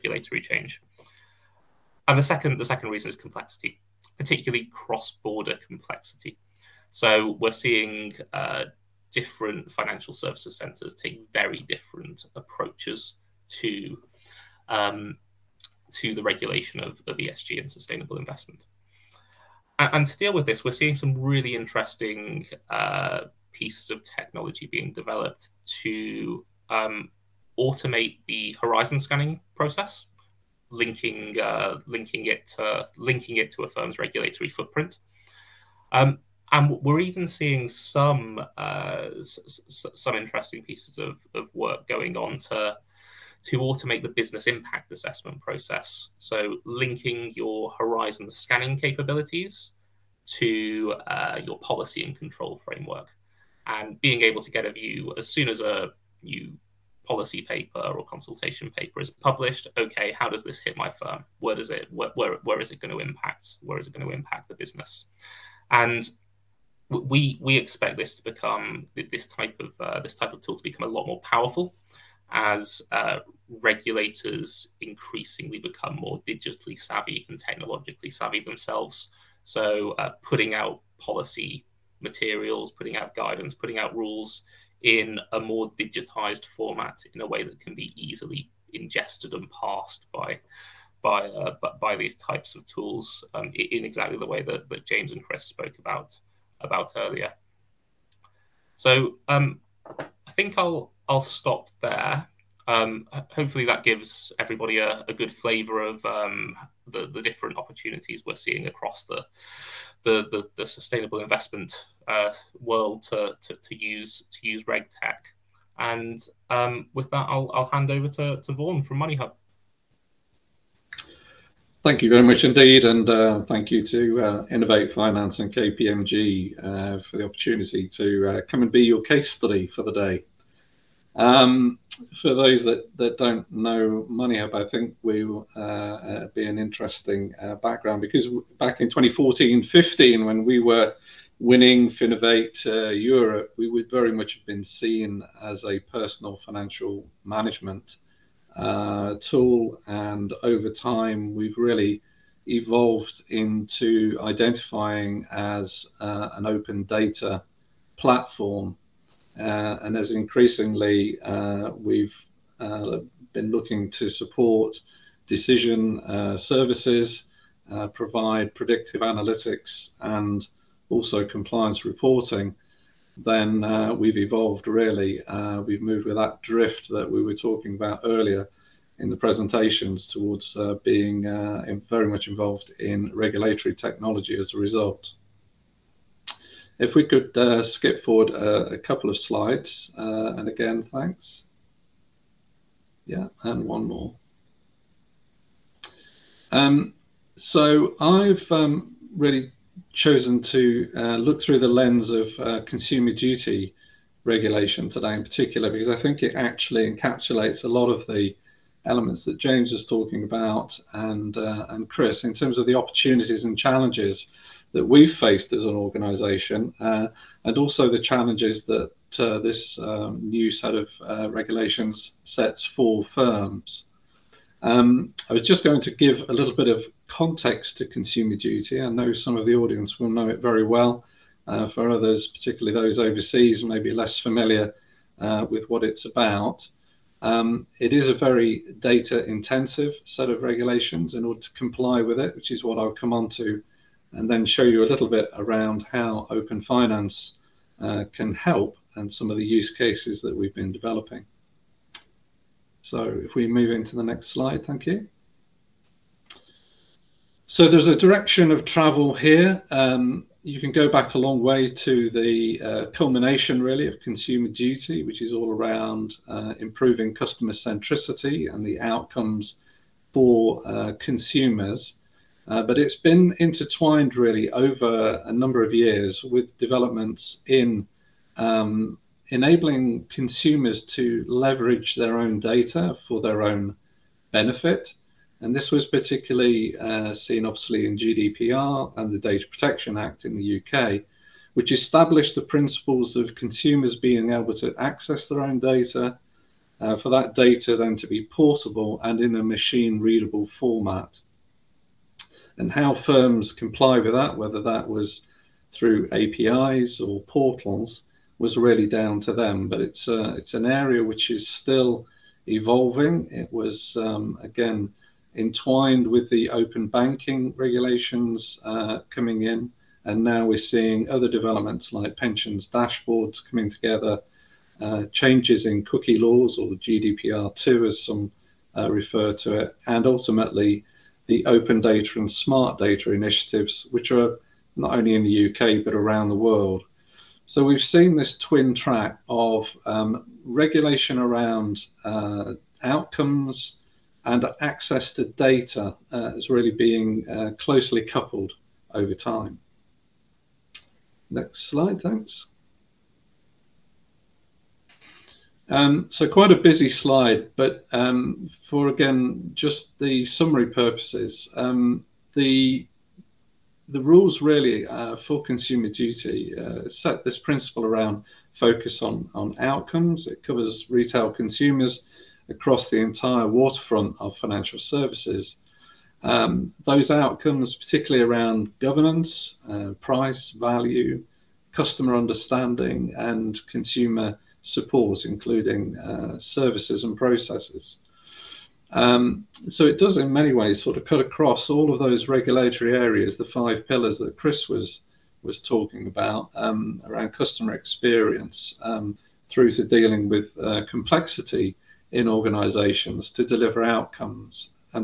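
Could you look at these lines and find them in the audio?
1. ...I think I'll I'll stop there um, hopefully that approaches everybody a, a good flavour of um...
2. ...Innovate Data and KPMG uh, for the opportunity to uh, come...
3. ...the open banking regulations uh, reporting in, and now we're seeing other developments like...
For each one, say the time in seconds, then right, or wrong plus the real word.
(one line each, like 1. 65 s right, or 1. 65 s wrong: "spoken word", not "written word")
1. 99 s wrong: "gives", not "approaches"
2. 124 s wrong: "Finance", not "Data"
3. 316 s wrong: "coming", not "reporting".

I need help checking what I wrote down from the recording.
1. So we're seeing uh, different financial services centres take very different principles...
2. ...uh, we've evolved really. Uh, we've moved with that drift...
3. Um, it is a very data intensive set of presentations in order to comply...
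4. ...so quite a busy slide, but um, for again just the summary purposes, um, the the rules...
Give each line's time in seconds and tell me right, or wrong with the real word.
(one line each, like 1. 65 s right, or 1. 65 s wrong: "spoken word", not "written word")
1. 6 s wrong: "approaches", not "principles"
2. 173 s right
3. 237 s wrong: "regulations", not "presentations"
4. 356 s right.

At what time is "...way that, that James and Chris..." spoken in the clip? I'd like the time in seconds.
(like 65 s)
94 s.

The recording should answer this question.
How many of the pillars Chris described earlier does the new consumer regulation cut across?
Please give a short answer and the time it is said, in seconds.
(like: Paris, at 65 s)
5, at 393 s.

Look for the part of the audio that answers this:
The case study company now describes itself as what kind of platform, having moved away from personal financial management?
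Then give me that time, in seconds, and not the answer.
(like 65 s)
156 s.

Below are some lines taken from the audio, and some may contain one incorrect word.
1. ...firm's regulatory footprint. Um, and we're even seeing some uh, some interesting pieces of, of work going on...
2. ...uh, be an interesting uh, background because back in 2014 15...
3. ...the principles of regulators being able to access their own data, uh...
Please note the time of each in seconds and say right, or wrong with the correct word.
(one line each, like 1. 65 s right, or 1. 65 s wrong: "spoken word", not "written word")
1. 33 s right
2. 135 s right
3. 292 s wrong: "consumers", not "regulators".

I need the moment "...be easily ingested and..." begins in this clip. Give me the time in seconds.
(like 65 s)
87 s.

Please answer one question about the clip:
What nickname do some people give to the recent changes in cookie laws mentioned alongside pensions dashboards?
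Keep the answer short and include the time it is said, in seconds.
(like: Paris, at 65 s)
GDPR2, at 326 s.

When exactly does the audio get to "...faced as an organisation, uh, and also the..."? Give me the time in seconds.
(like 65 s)
215 s.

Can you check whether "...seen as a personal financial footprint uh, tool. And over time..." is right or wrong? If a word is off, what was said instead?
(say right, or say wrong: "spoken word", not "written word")
wrong: "management", not "footprint".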